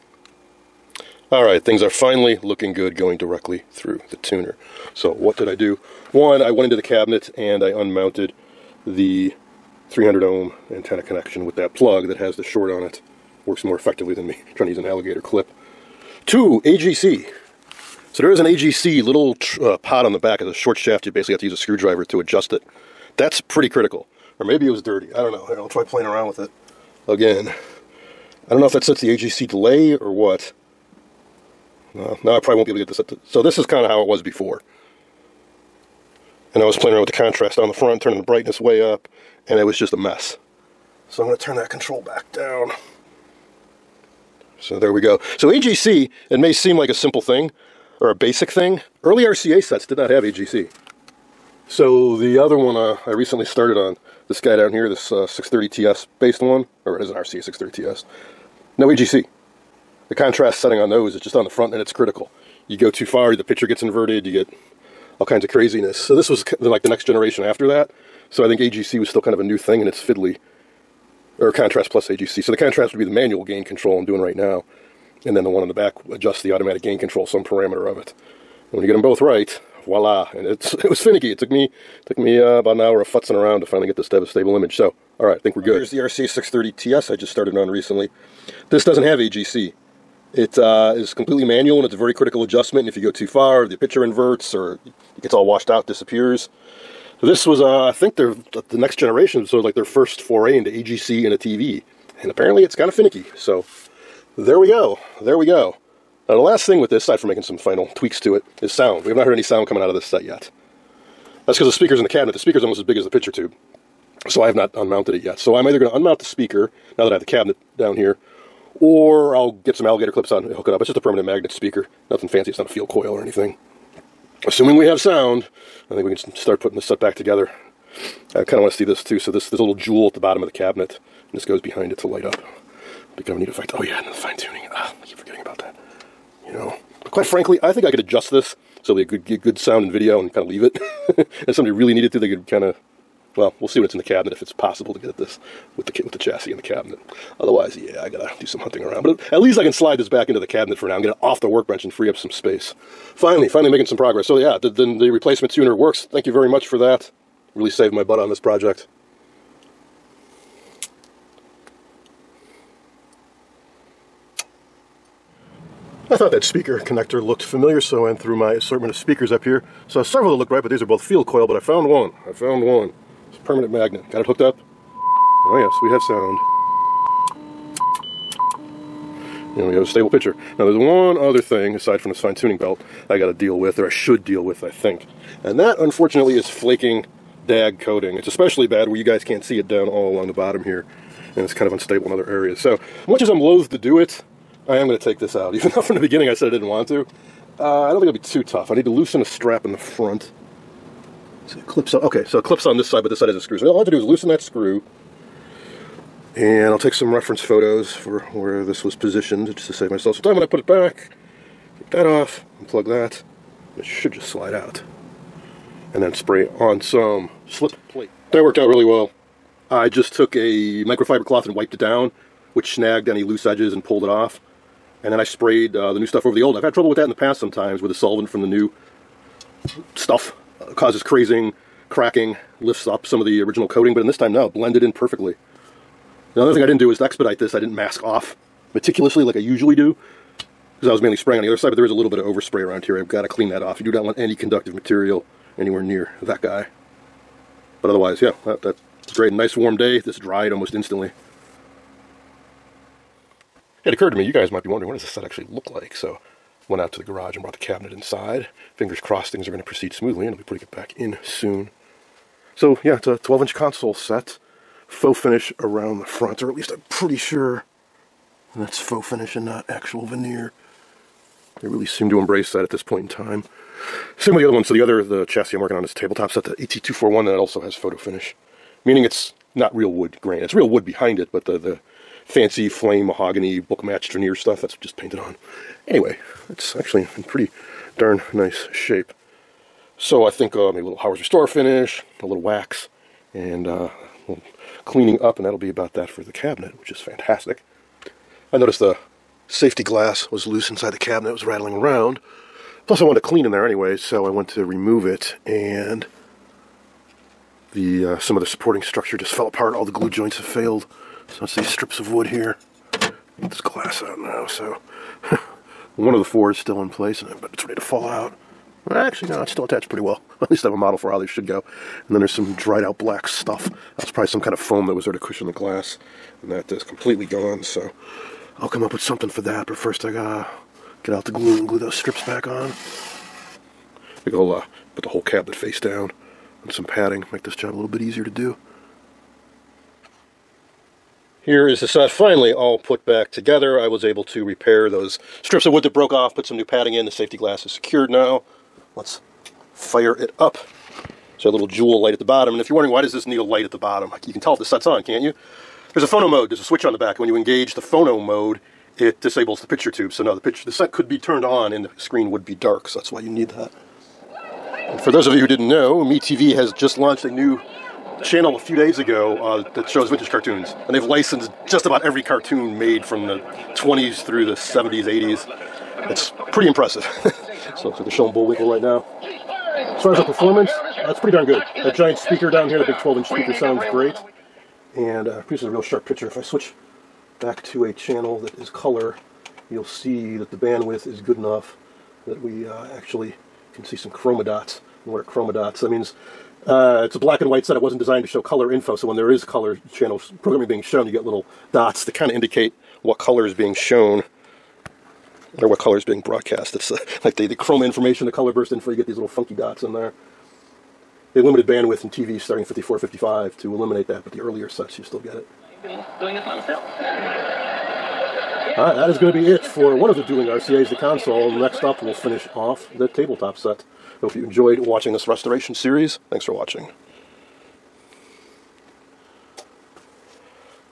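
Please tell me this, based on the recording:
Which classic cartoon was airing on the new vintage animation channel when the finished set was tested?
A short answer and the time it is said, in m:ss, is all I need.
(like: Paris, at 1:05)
Bullwinkle, at 6:18.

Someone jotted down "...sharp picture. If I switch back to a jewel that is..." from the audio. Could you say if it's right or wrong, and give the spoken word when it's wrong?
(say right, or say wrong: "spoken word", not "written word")
wrong: "channel", not "jewel".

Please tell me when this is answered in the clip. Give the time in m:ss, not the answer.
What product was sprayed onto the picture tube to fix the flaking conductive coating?
3:37.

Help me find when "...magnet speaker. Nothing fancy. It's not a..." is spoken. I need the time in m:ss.
2:01.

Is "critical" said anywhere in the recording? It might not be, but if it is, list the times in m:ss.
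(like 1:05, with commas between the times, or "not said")
0:23, 1:01, 1:32.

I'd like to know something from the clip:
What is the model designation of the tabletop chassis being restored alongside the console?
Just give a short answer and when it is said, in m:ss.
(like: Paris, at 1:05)
8T241, at 4:36.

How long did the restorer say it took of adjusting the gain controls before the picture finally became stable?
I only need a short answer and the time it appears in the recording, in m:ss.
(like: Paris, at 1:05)
about an hour, at 1:22.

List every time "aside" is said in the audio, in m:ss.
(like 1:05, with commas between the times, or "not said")
1:47, 3:01.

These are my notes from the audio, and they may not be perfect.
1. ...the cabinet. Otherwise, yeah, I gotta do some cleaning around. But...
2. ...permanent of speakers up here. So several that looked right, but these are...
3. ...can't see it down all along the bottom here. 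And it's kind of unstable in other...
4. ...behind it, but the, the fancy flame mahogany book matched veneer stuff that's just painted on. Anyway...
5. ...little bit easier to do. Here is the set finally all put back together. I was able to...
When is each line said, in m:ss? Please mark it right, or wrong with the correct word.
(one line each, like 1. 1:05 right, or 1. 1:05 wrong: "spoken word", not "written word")
1. 2:26 wrong: "hunting", not "cleaning"
2. 2:48 wrong: "assortment", not "permanent"
3. 3:09 right
4. 4:40 right
5. 5:37 right.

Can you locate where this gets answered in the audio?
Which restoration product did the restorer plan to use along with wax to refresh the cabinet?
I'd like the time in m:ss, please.
4:50.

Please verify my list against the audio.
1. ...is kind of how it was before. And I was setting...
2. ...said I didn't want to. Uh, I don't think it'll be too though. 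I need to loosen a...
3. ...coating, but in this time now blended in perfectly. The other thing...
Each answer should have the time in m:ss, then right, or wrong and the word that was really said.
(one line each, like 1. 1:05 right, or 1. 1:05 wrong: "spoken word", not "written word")
1. 0:33 wrong: "playing", not "setting"
2. 3:16 wrong: "tough", not "though"
3. 3:53 right.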